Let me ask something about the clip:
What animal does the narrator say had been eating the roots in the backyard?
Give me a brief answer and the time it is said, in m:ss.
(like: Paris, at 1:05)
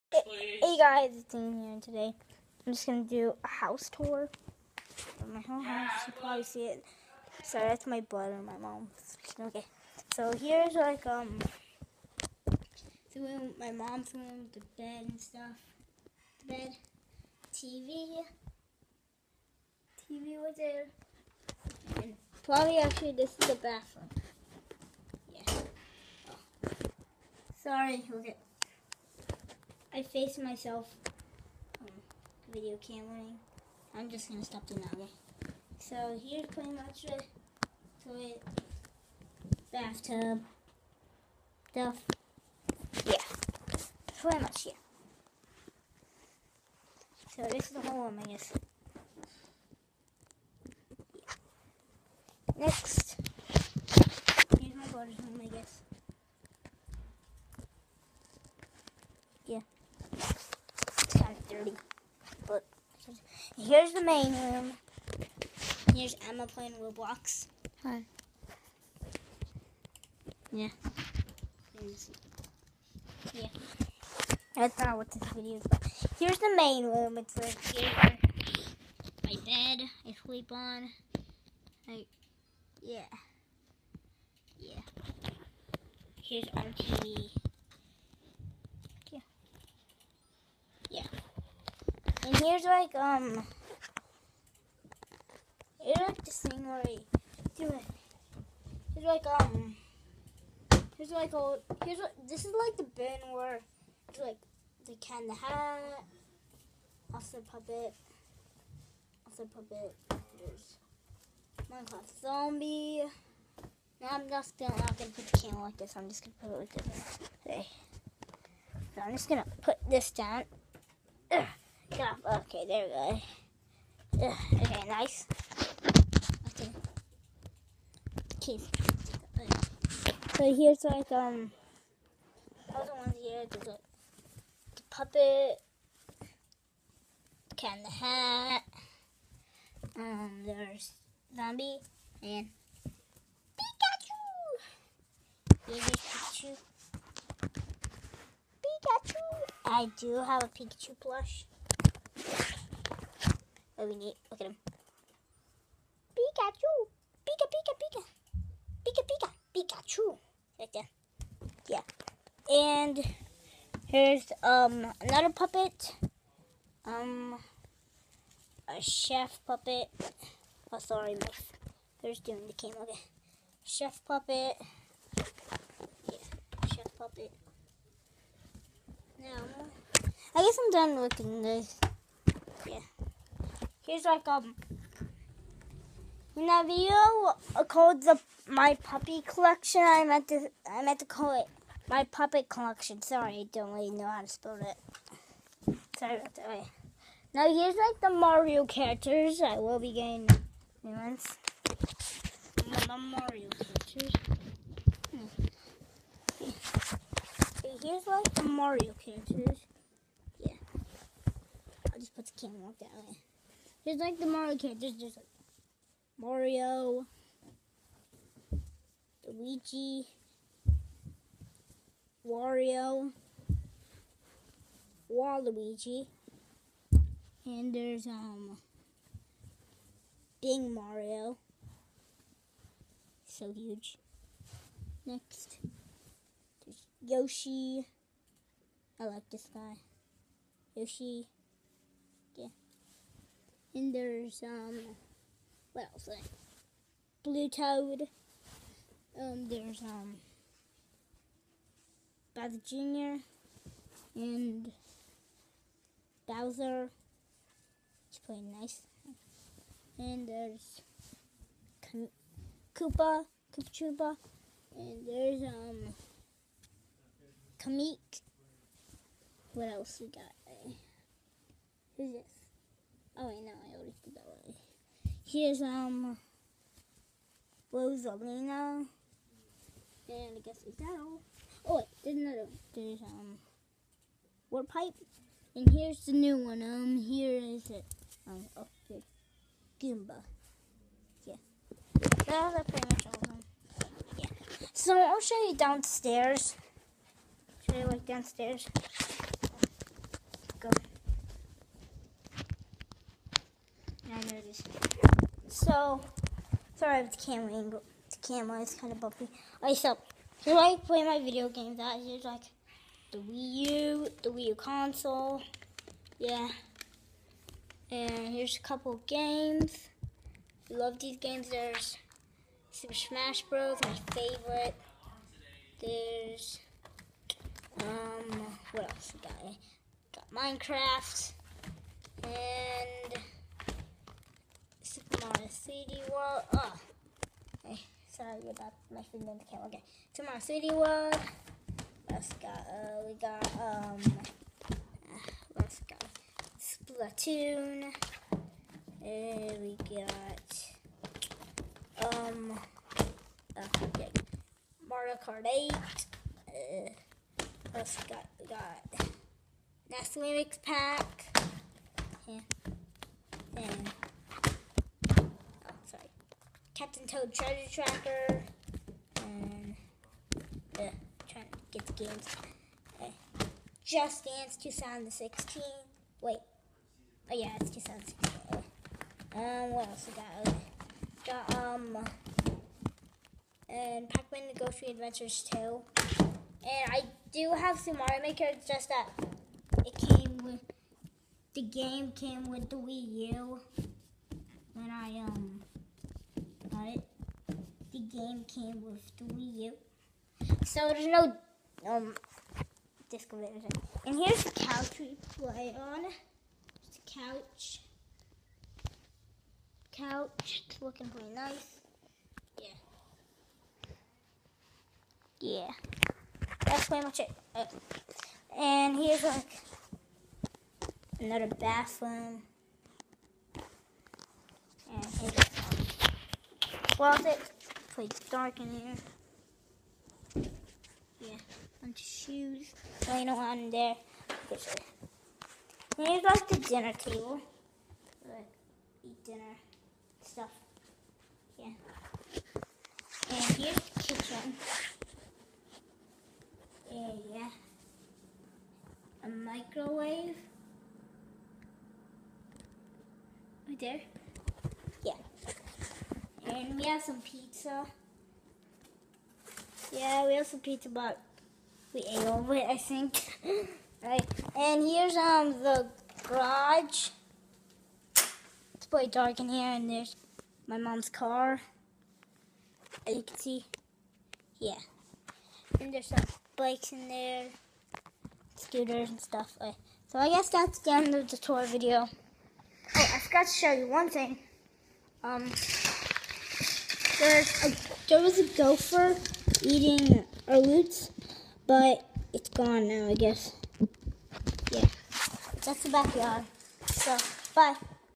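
A gopher, at 8:08.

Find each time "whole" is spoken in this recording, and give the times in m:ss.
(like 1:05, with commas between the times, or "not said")
0:05, 0:47.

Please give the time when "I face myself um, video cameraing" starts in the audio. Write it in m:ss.
0:29.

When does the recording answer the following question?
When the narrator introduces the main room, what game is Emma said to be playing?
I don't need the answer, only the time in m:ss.
1:06.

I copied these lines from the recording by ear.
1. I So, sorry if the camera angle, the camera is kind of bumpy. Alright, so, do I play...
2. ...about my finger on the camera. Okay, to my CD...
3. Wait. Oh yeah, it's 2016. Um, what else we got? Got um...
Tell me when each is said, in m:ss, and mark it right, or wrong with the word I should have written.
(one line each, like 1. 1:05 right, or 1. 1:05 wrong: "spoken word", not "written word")
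1. 5:04 right
2. 5:38 right
3. 6:16 right.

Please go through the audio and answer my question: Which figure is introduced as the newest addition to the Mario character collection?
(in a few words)
Goomba.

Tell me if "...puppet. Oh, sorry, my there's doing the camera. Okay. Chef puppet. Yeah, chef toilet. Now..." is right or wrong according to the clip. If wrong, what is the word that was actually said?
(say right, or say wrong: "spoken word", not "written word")
wrong: "puppet", not "toilet".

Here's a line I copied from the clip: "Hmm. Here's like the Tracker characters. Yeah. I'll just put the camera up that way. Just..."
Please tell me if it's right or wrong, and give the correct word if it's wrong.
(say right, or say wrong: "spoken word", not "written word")
wrong: "Mario", not "Tracker".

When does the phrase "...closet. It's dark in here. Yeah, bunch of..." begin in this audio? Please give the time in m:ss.
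7:06.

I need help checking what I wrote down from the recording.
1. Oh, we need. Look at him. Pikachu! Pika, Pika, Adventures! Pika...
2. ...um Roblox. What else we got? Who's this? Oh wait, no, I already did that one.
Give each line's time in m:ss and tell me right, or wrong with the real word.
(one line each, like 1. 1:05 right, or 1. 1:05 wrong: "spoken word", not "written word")
1. 2:33 wrong: "Pika", not "Adventures"
2. 4:25 wrong: "Kamek", not "Roblox".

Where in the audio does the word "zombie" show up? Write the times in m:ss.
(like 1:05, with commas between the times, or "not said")
1:52, 2:21.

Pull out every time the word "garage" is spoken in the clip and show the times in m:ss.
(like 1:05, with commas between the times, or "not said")
7:46.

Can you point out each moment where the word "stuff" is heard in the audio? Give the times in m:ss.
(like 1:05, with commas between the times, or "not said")
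0:15, 0:41, 7:20, 7:59.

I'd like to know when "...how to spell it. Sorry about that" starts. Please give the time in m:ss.
3:14.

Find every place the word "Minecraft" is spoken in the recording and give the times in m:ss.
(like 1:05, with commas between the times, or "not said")
1:51, 5:30.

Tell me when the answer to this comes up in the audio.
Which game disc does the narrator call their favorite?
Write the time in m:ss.
5:22.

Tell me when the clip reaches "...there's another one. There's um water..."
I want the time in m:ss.
4:42.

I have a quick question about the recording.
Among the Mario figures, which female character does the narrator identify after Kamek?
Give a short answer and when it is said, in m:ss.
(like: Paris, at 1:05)
Rosalina, at 4:37.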